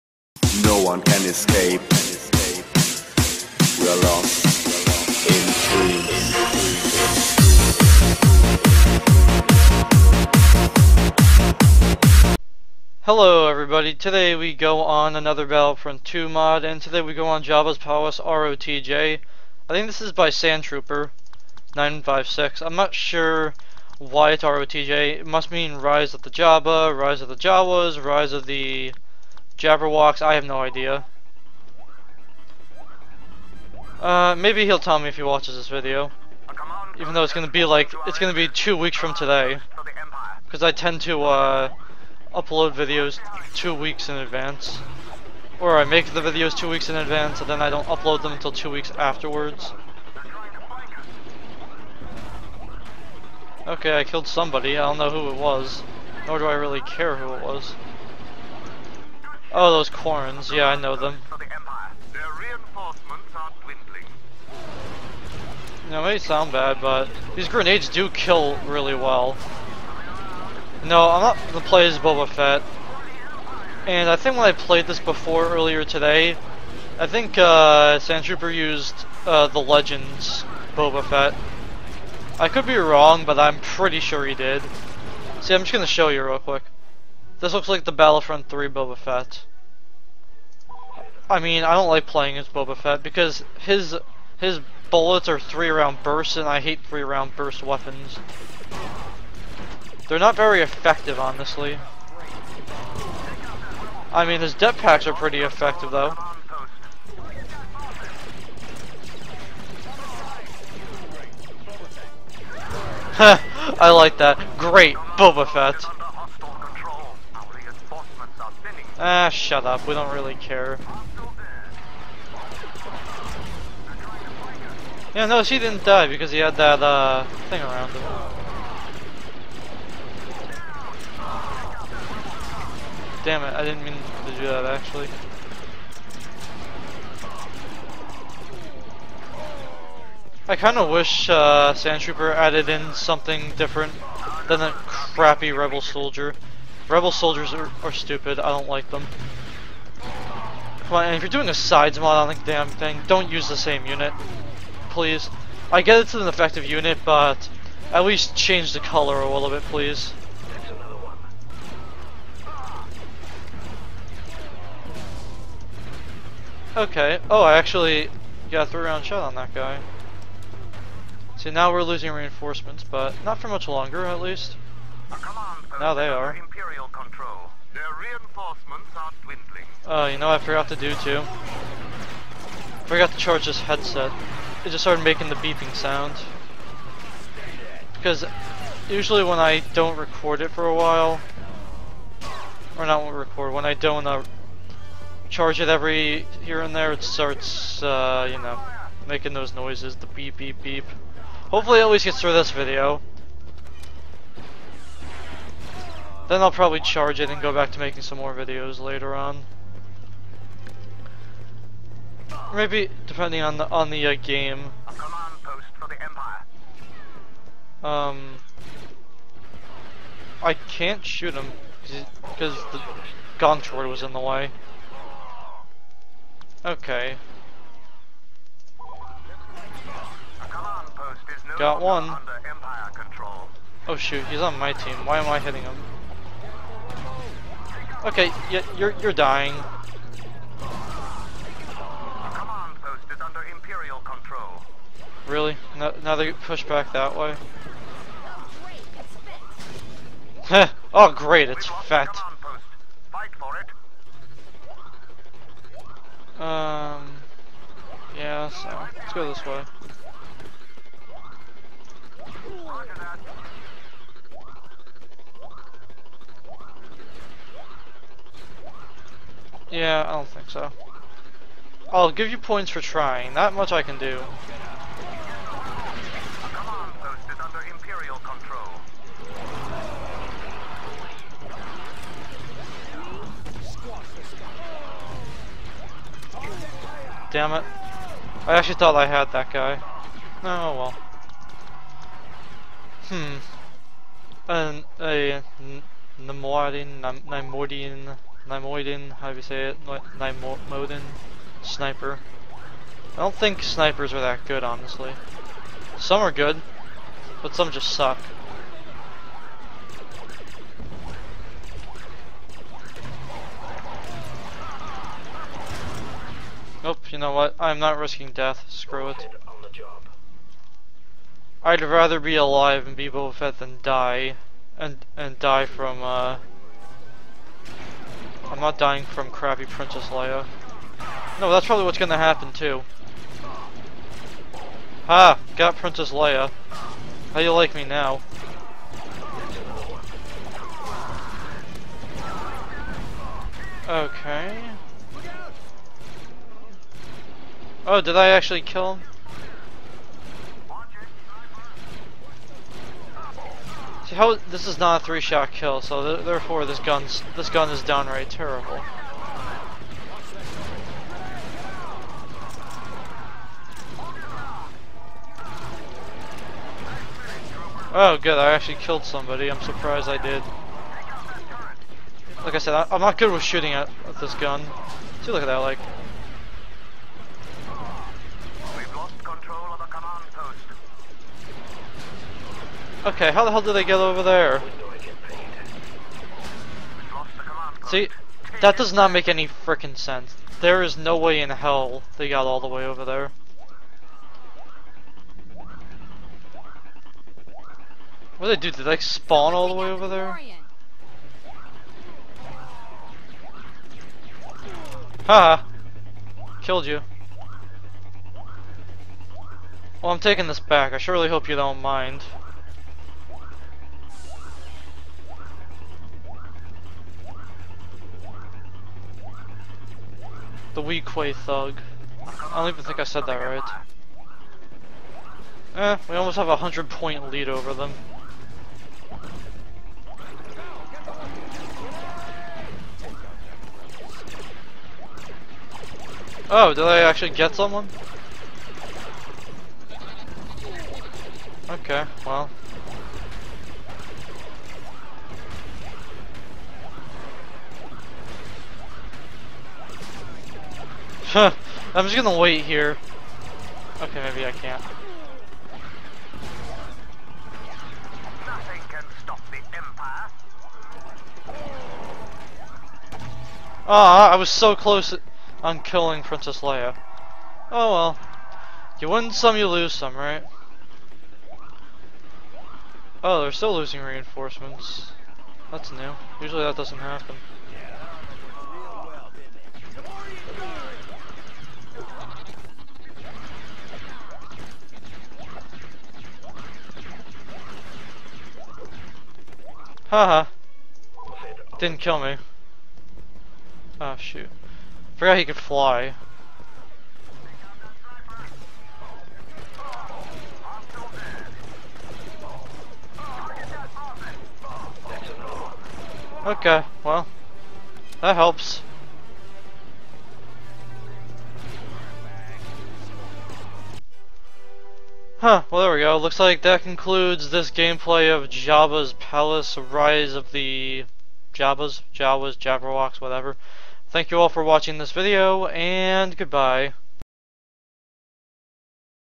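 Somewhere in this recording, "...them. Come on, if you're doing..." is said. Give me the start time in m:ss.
2:28.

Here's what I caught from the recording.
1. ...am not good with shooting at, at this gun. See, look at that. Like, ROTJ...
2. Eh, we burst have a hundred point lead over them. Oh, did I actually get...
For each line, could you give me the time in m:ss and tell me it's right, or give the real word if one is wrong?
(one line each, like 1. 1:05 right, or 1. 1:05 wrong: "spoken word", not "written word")
1. 6:12 wrong: "Okay", not "ROTJ"
2. 7:05 wrong: "almost", not "burst".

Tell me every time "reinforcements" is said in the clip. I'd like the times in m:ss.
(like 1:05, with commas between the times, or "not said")
2:52, 2:57, 7:54.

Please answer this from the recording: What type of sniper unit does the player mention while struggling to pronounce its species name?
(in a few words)
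Nimoiden sniper.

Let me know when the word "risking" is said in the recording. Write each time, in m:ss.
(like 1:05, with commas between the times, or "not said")
5:17.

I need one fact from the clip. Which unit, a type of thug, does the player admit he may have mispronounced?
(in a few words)
Weequay thug.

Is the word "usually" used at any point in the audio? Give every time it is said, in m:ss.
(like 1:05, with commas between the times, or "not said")
3:08, 7:56.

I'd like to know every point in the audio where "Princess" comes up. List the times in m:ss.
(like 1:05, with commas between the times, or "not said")
5:29, 5:35, 7:46.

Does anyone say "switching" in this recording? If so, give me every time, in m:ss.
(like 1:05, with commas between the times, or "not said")
not said.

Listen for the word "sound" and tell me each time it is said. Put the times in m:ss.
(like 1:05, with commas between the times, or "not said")
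1:06, 3:05.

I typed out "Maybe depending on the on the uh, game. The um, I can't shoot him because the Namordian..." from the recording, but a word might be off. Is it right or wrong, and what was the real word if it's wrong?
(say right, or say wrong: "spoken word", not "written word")
wrong: "Gontord", not "Namordian".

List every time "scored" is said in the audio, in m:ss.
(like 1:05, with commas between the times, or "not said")
not said.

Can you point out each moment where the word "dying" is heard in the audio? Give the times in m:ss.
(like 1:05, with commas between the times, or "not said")
3:59, 5:28.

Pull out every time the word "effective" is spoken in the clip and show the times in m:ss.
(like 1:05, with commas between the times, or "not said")
1:40, 1:45, 2:36.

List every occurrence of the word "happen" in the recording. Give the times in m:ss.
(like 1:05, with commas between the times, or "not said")
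5:32, 7:56.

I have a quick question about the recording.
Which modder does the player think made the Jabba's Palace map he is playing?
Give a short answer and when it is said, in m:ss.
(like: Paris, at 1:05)
Sandtrooper 956, at 0:20.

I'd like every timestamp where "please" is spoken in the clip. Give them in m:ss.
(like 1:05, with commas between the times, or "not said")
2:34, 2:39.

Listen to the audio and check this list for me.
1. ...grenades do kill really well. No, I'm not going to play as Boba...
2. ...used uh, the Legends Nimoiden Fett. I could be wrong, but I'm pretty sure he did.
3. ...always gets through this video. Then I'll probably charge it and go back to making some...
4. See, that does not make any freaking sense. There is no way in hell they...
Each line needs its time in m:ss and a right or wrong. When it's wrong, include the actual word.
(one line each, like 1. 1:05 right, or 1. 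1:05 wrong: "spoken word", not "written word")
1. 1:07 right
2. 1:18 wrong: "Boba", not "Nimoiden"
3. 3:21 right
4. 6:27 right.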